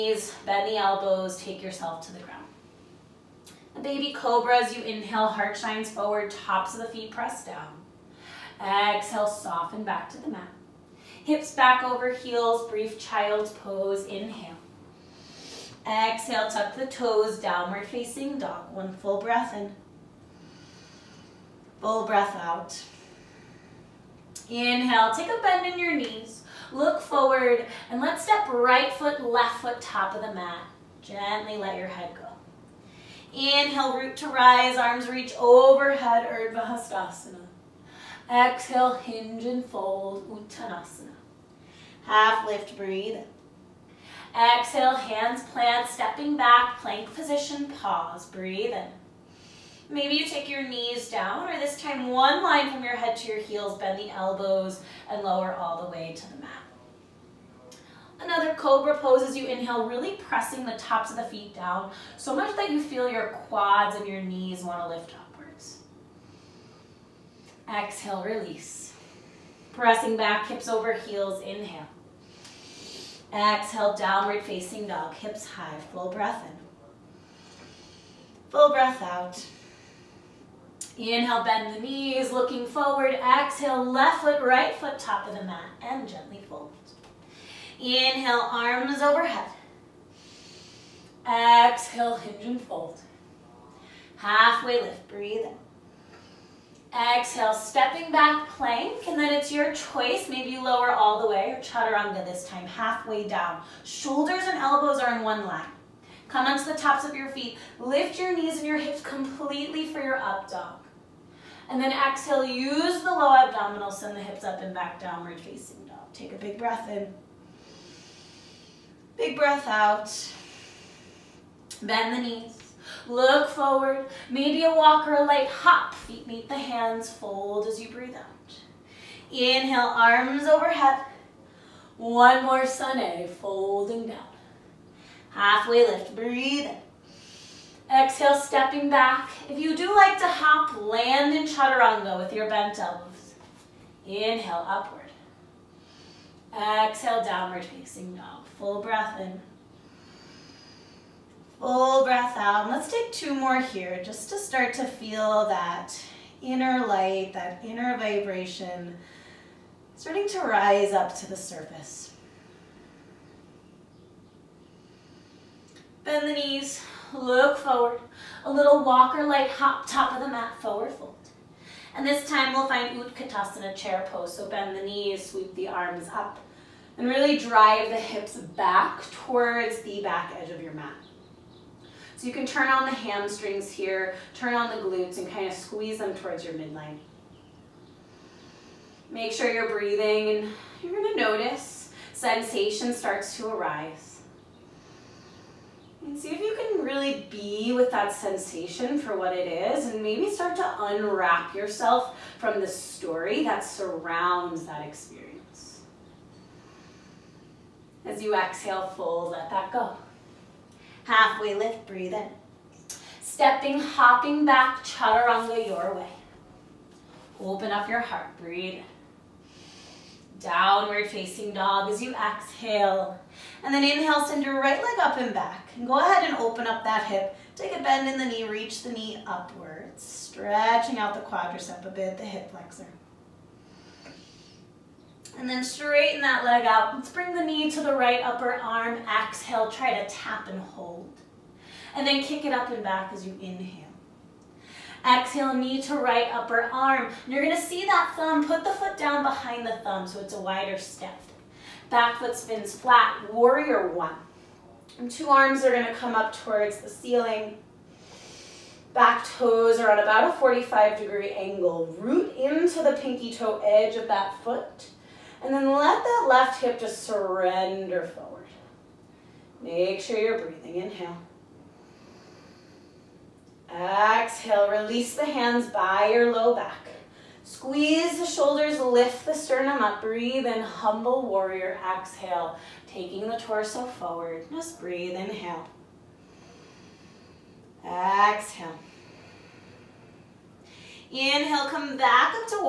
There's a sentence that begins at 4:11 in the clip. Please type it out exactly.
Back foot spins flat, warrior one.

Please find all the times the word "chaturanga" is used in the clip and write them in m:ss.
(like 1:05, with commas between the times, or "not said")
1:41, 2:21, 3:34.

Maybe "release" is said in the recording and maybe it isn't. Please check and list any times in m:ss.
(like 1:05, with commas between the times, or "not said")
1:08, 4:34.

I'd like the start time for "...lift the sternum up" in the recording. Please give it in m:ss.
4:38.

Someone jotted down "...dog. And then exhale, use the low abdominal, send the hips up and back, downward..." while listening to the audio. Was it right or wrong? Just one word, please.
right.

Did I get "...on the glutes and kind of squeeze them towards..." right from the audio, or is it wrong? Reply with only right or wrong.
right.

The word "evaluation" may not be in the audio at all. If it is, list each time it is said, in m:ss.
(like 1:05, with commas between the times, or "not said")
not said.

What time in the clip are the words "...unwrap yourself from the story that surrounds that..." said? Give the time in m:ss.
3:20.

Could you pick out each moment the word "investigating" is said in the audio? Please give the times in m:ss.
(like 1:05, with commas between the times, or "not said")
not said.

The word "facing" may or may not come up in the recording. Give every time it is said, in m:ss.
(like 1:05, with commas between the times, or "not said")
0:17, 1:14, 1:55, 2:27, 3:41.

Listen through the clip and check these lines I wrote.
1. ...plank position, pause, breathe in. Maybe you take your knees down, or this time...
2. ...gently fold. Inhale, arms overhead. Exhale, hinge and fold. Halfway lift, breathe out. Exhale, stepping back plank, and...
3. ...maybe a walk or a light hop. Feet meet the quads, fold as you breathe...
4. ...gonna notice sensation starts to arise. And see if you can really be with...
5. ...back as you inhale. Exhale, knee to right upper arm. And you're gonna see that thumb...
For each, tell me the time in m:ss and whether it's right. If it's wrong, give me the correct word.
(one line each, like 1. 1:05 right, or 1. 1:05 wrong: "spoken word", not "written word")
1. 0:46 right
2. 1:26 right
3. 2:04 wrong: "hands", not "quads"
4. 3:11 right
5. 4:02 right.